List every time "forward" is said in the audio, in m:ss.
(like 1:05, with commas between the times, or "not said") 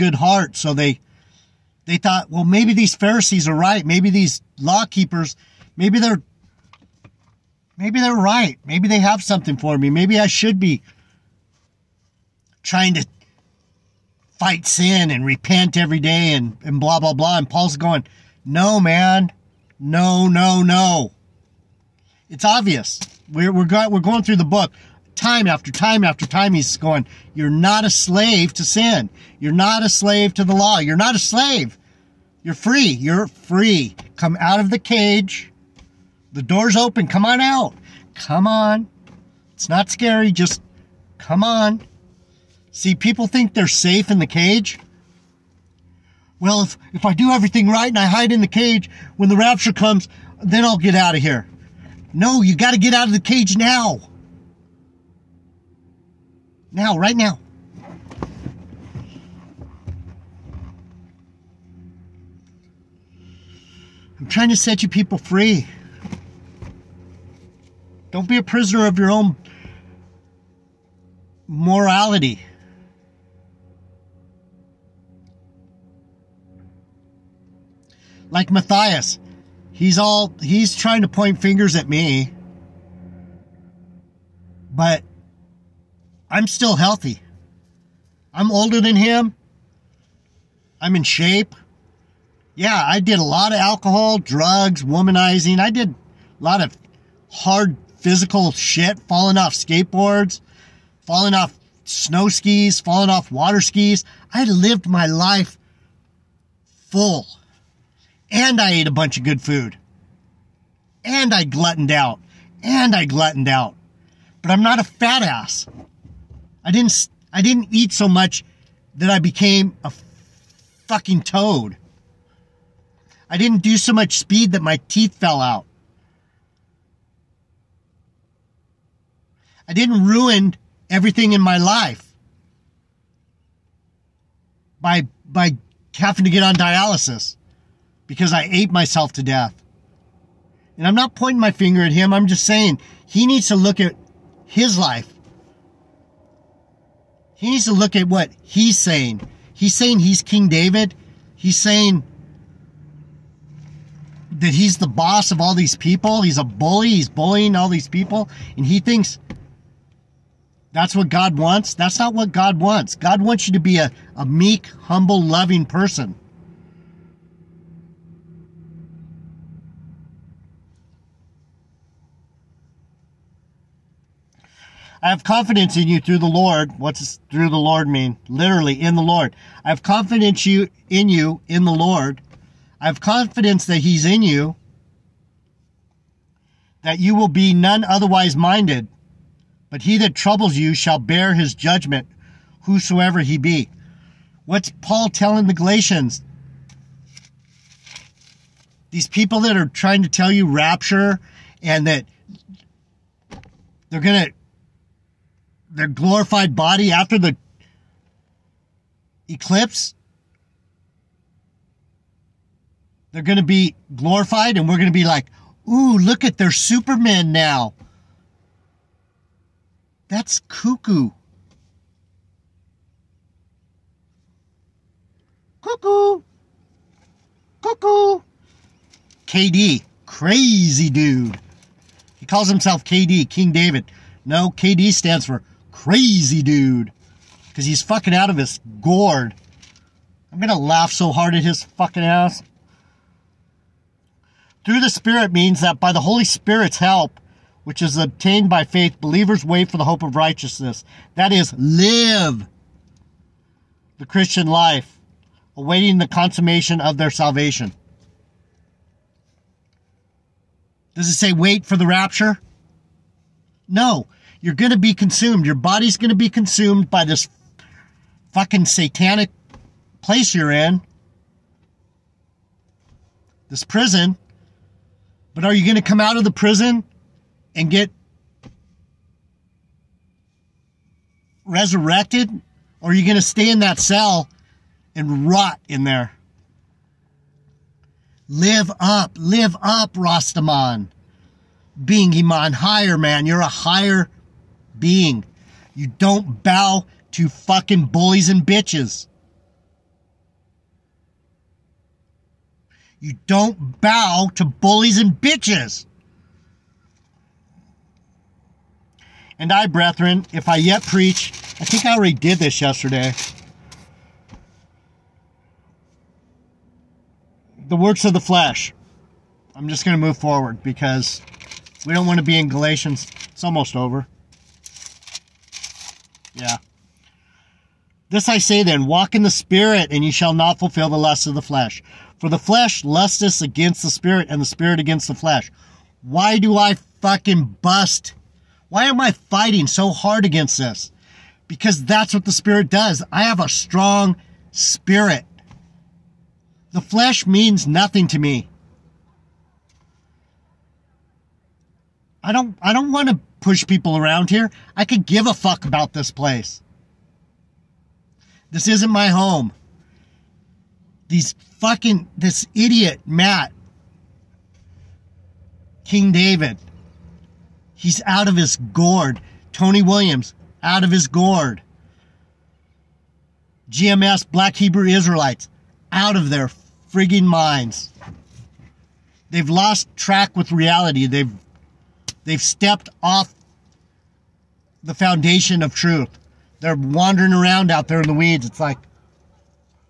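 5:20.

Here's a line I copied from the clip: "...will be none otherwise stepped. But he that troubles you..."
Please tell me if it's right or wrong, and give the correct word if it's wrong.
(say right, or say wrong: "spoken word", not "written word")
wrong: "minded", not "stepped".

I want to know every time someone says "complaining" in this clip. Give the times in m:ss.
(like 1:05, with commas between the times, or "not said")
not said.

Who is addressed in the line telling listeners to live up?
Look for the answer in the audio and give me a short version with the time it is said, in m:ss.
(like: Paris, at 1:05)
Rastaman, at 4:49.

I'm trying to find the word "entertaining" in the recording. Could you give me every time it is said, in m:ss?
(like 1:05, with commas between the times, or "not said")
not said.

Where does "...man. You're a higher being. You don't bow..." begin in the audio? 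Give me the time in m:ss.
4:52.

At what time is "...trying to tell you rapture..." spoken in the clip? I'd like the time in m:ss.
3:19.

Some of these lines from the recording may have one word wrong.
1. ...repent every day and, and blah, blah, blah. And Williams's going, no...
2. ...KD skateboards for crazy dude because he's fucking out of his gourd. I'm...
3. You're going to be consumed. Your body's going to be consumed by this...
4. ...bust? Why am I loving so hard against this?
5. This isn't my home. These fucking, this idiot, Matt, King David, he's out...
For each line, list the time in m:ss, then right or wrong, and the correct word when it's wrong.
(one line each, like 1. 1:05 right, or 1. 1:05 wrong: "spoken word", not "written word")
1. 0:15 wrong: "Paul", not "Williams"
2. 3:54 wrong: "stands", not "skateboards"
3. 4:24 right
4. 5:37 wrong: "fighting", not "loving"
5. 5:58 right.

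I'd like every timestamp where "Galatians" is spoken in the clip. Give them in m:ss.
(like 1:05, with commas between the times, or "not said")
3:15, 5:22.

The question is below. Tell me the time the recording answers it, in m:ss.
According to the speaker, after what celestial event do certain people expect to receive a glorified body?
3:29.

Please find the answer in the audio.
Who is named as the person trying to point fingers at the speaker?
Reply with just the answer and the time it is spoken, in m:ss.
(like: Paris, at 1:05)
Matthias, at 1:18.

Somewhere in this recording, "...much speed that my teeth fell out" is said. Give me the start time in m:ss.
2:03.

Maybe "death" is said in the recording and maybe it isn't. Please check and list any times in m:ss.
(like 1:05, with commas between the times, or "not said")
2:19.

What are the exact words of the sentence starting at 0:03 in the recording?
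Maybe these law keepers, maybe they're maybe they're right.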